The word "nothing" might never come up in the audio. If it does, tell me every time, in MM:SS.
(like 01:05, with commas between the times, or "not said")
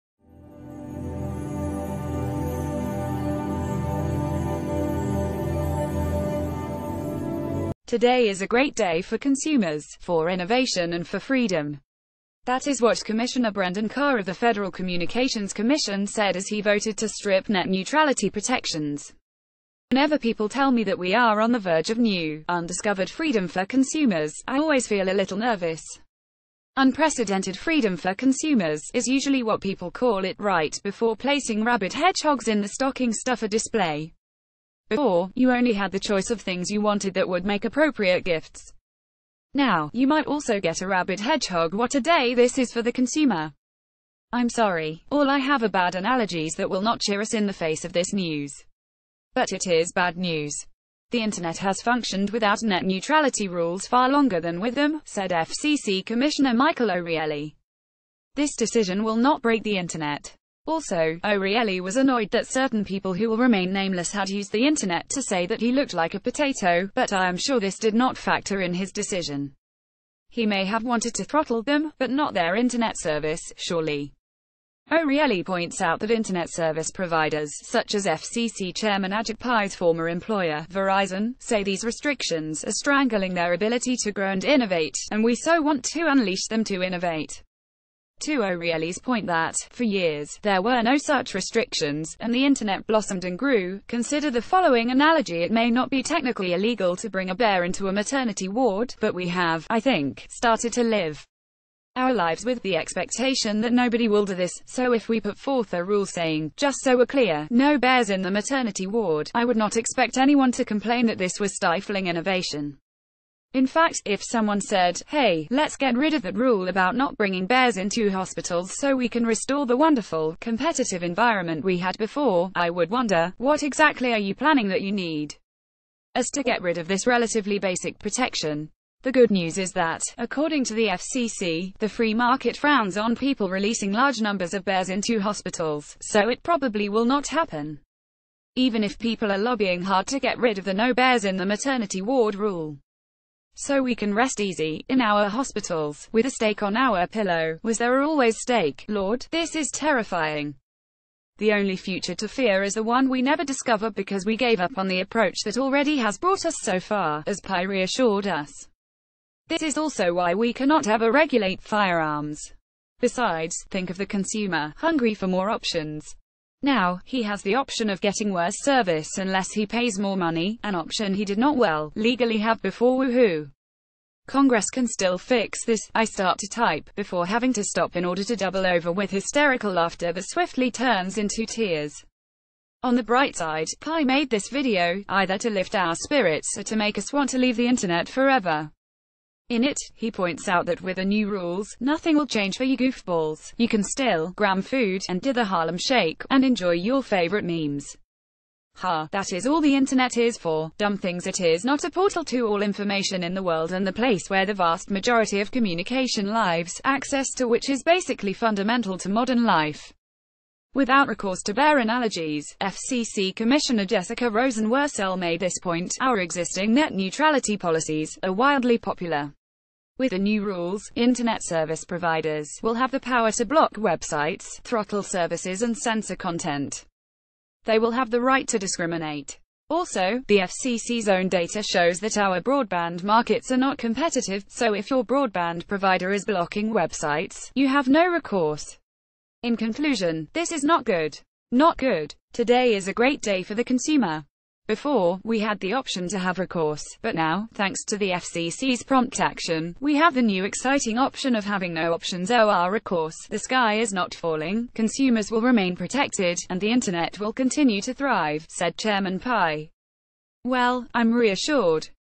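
03:11.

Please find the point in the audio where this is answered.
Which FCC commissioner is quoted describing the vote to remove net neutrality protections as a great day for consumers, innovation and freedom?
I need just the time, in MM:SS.
00:13.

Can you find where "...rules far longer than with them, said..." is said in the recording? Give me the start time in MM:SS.
00:53.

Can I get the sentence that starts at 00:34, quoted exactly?
Before, you only had the choice of things you wanted that would make appropriate gifts.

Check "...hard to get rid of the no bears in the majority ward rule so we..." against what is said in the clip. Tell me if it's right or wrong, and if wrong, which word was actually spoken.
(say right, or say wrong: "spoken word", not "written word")
wrong: "maternity", not "majority".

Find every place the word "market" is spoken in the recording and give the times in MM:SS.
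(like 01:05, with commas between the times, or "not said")
02:12, 03:53.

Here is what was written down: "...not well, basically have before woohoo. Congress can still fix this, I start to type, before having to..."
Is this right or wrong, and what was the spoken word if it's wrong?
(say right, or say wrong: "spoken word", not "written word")
wrong: "legally", not "basically".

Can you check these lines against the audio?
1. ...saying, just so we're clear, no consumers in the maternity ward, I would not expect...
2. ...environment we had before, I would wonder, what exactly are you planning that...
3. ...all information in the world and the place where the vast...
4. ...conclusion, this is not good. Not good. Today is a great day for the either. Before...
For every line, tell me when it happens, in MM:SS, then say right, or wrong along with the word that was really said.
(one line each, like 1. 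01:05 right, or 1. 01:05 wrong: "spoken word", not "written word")
1. 01:46 wrong: "bears", not "consumers"
2. 02:01 right
3. 03:22 right
4. 03:59 wrong: "consumer", not "either".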